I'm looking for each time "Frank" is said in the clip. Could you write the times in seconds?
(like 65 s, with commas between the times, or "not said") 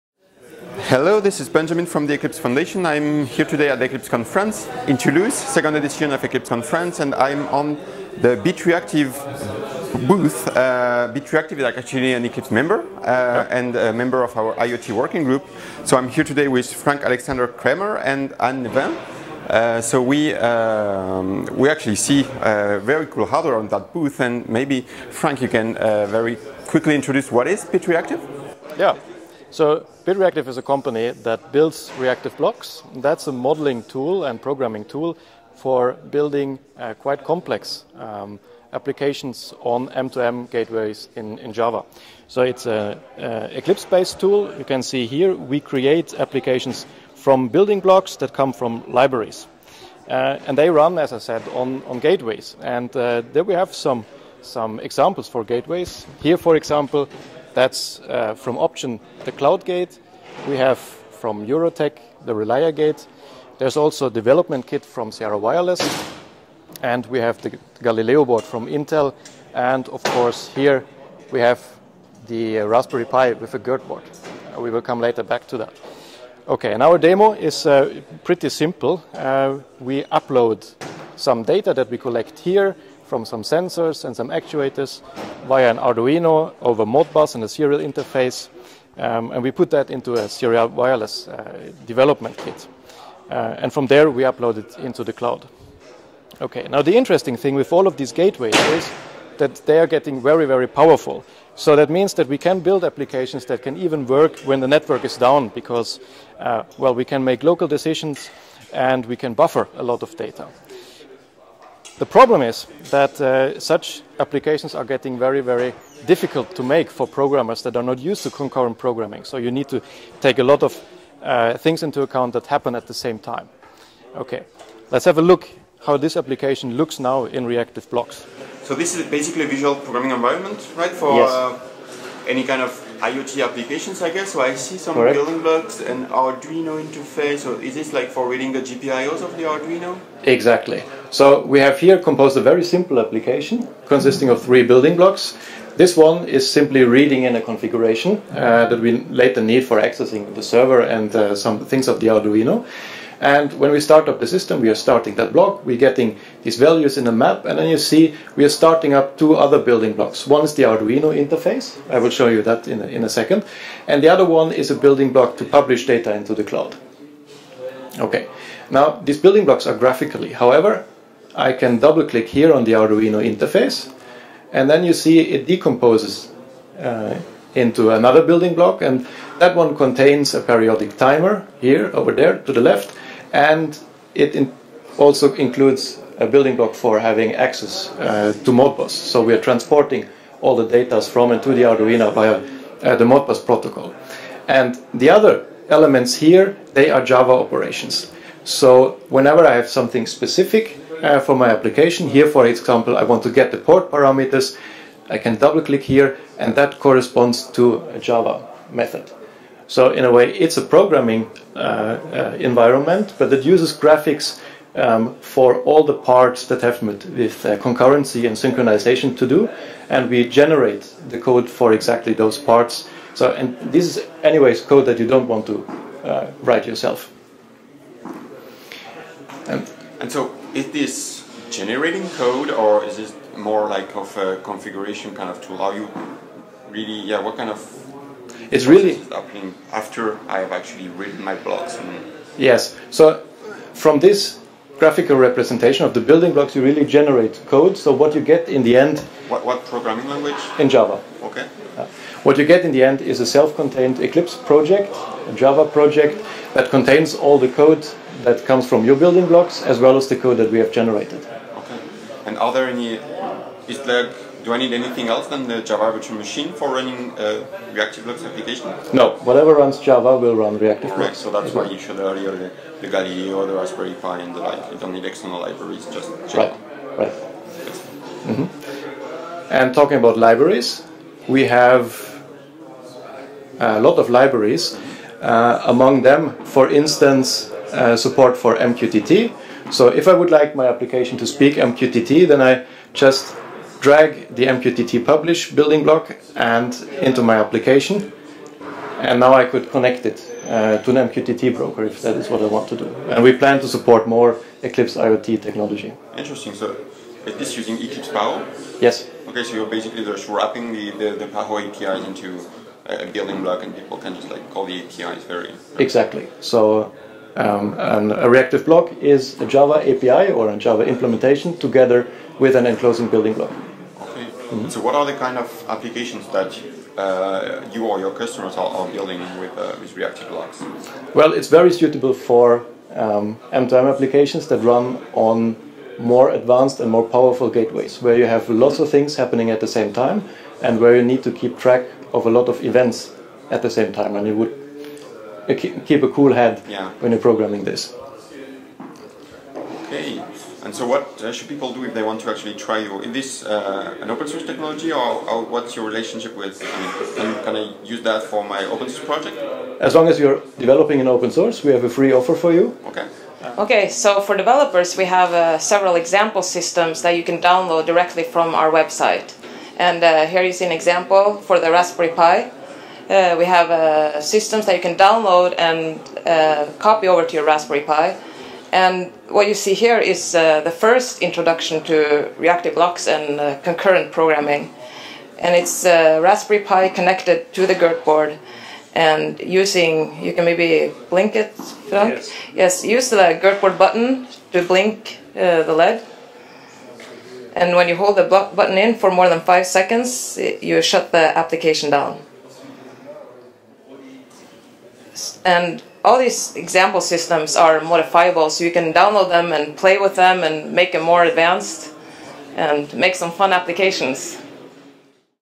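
16 s, 25 s, 391 s.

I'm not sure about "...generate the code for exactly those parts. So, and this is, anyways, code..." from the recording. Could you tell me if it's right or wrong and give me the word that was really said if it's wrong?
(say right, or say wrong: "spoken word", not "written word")
right.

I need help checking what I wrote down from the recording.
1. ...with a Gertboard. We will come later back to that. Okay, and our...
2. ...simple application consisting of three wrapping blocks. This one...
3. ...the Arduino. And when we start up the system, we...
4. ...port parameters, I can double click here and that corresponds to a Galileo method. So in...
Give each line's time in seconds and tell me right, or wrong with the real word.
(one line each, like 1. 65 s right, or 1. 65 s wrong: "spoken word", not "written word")
1. 73 s right
2. 142 s wrong: "building", not "wrapping"
3. 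151 s right
4. 203 s wrong: "Java", not "Galileo".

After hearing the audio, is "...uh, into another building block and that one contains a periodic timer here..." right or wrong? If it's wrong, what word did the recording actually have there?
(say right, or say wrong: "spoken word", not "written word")
right.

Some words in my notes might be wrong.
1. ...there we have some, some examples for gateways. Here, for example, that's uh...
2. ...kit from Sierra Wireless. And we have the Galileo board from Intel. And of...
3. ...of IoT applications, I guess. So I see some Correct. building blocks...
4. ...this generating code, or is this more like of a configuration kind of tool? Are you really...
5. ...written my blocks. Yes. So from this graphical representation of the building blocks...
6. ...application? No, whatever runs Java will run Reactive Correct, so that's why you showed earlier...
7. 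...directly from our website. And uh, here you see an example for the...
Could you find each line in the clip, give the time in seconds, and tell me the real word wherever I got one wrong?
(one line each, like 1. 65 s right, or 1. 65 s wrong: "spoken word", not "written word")
1. 53 s right
2. 64 s right
3. 132 s right
4. 230 s right
5. 240 s right
6. 268 s right
7. 367 s right.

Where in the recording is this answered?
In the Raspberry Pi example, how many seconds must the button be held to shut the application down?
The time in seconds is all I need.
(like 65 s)
399 s.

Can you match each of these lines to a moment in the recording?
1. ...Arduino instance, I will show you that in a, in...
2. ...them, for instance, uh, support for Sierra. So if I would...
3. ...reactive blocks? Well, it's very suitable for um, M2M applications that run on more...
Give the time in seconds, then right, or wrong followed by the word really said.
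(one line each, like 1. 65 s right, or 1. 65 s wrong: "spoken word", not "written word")
1. 160 s wrong: "interface", not "instance"
2. 286 s wrong: "MQTT", not "Sierra"
3. 329 s right.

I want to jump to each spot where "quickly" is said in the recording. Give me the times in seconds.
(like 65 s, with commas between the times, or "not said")
26 s.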